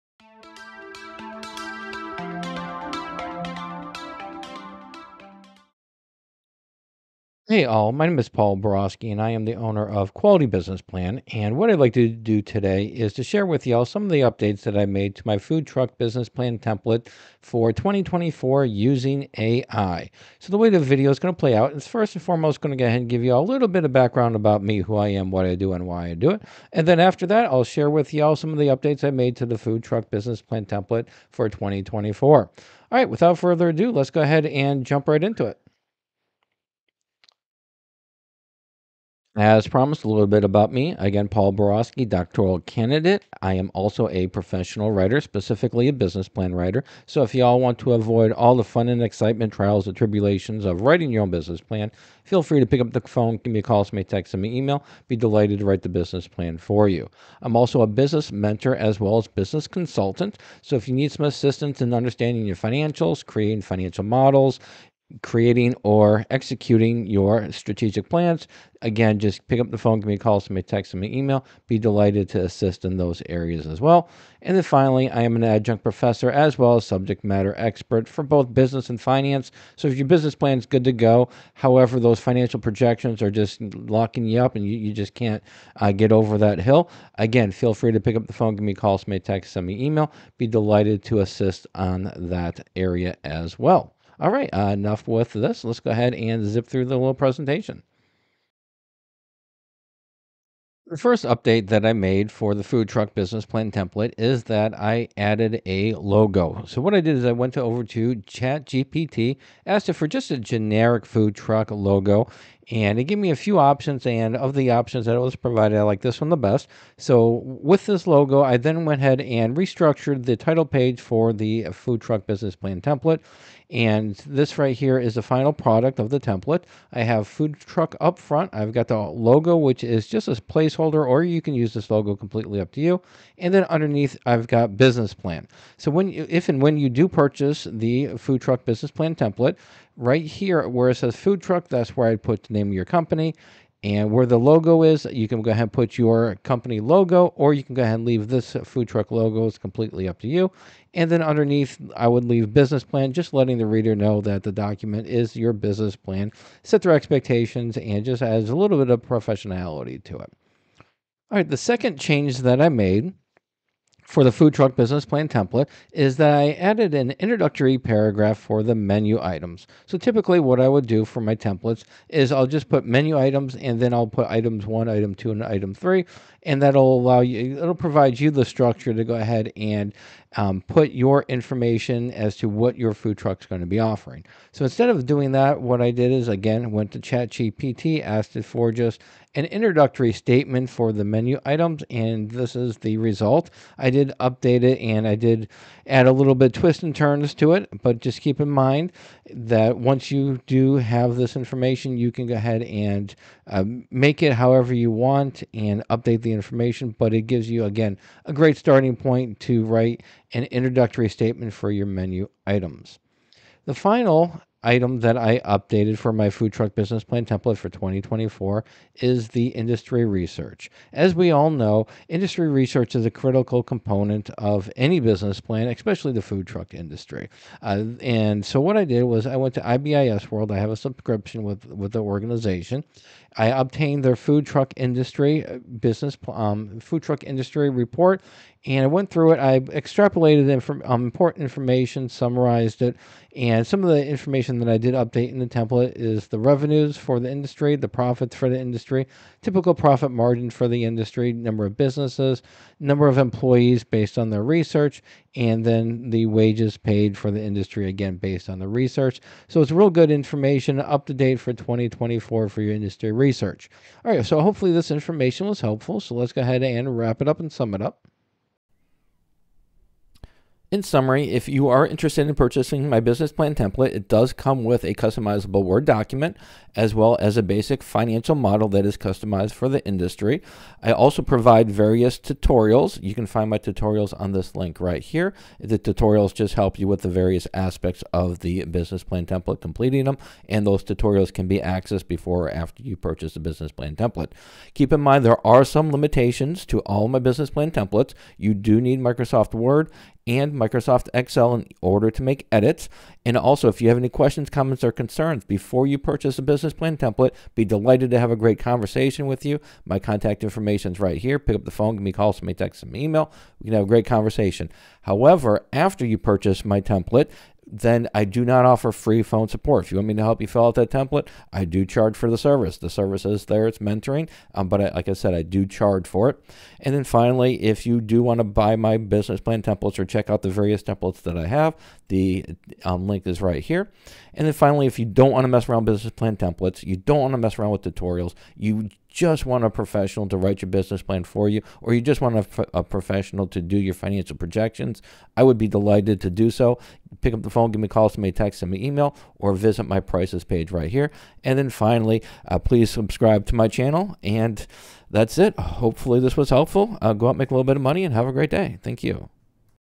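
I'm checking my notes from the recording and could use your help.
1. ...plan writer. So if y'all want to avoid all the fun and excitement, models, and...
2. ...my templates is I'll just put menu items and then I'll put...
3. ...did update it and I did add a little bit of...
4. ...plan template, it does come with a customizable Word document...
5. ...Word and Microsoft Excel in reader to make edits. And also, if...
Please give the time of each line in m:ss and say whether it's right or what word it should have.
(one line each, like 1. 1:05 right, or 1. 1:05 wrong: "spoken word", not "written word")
1. 0:46 wrong: "trials", not "models"
2. 2:51 right
3. 3:13 right
4. 4:33 right
5. 4:59 wrong: "order", not "reader".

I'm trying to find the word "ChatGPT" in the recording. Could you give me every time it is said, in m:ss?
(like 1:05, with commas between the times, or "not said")
1:48, 3:06.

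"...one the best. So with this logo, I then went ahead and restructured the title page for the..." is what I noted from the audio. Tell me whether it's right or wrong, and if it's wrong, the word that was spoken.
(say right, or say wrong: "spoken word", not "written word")
right.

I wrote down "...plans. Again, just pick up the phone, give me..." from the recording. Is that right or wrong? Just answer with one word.
right.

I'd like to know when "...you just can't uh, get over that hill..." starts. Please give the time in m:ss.
1:24.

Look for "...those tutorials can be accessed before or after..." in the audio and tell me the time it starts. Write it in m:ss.
4:50.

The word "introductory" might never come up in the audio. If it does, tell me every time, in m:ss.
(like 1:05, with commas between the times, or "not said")
2:47, 3:09, 3:30.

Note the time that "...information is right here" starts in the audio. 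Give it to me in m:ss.
5:10.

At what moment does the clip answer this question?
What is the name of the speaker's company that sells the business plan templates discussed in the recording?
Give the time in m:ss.
0:10.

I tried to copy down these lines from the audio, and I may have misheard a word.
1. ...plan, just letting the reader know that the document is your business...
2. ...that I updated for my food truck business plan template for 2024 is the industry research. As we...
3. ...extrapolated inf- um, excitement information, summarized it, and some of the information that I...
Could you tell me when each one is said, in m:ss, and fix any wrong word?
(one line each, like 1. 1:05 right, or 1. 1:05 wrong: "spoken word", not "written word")
1. 2:32 right
2. 3:34 right
3. 3:59 wrong: "important", not "excitement".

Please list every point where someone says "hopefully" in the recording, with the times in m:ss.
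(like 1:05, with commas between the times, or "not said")
4:24, 5:55.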